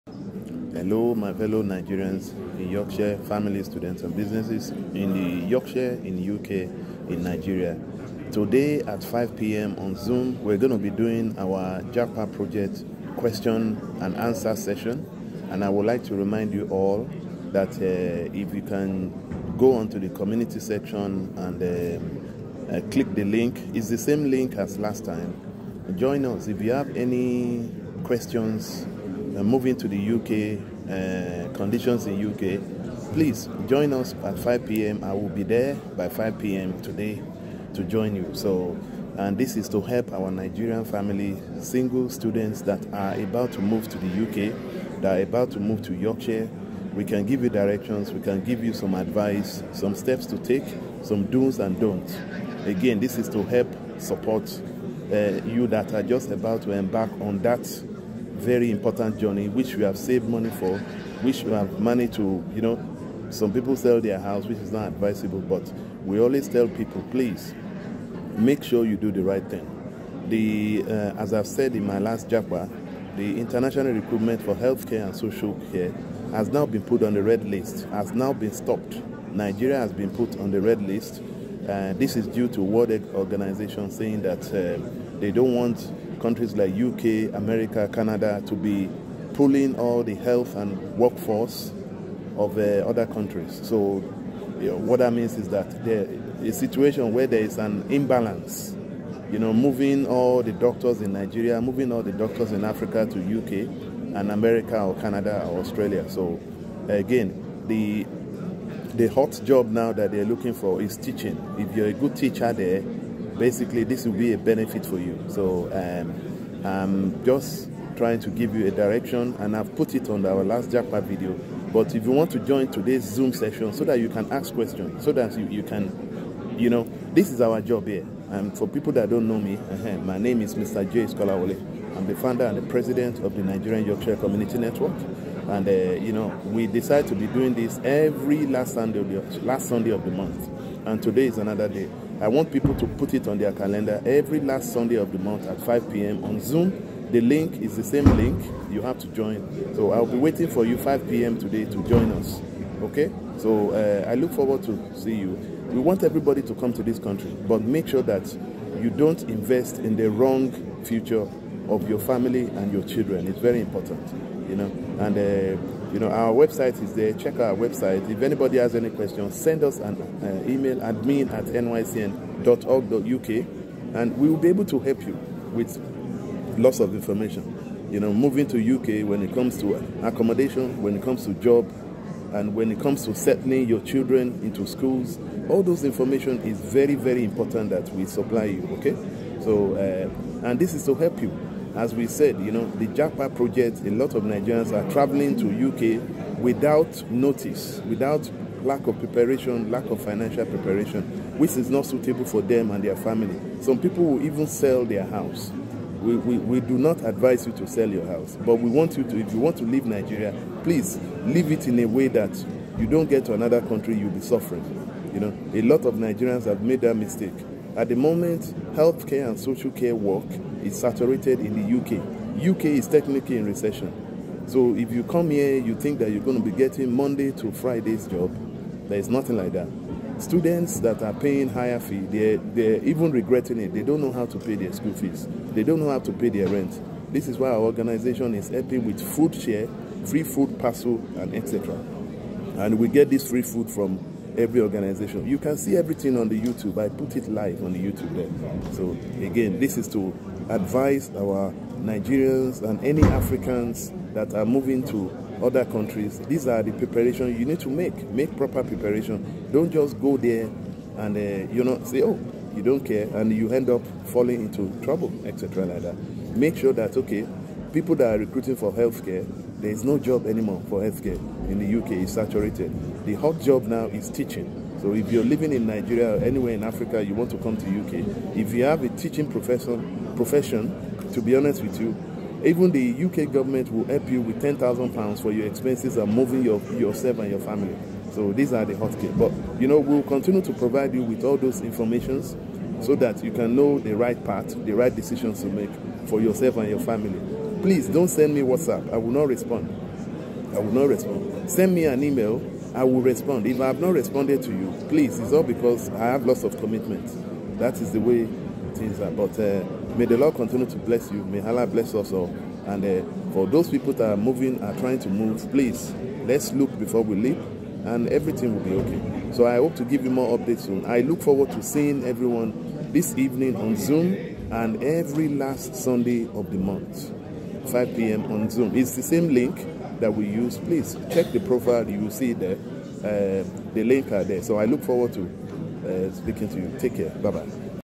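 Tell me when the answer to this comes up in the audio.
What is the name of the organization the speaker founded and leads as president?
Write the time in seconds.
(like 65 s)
133 s.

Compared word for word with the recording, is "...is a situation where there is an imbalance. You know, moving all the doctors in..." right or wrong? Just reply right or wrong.
right.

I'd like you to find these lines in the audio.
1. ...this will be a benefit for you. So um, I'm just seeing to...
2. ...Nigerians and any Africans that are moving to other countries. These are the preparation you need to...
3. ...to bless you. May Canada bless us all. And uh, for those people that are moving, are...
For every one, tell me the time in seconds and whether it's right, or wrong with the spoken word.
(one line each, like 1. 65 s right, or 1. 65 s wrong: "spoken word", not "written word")
1. 113 s wrong: "trying", not "seeing"
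2. 251 s right
3. 310 s wrong: "Allah", not "Canada".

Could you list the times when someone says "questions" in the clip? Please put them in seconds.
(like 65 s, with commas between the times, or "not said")
13 s, 28 s, 124 s, 168 s.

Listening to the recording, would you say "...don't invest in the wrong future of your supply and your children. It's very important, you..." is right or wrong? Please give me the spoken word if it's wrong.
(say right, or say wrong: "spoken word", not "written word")
wrong: "family", not "supply".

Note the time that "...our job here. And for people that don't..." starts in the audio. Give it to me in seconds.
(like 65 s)
127 s.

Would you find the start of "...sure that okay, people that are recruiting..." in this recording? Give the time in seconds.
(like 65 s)
266 s.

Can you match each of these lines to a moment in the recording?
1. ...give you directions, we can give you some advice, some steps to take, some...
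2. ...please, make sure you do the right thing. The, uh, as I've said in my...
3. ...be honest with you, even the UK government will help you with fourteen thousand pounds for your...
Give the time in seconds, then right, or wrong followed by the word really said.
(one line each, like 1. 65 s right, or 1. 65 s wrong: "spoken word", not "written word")
1. 47 s right
2. 67 s right
3. 281 s wrong: "ten", not "fourteen".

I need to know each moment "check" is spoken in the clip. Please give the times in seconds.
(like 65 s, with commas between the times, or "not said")
167 s, 331 s.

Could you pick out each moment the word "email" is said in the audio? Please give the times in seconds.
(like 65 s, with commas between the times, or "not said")
170 s, 302 s.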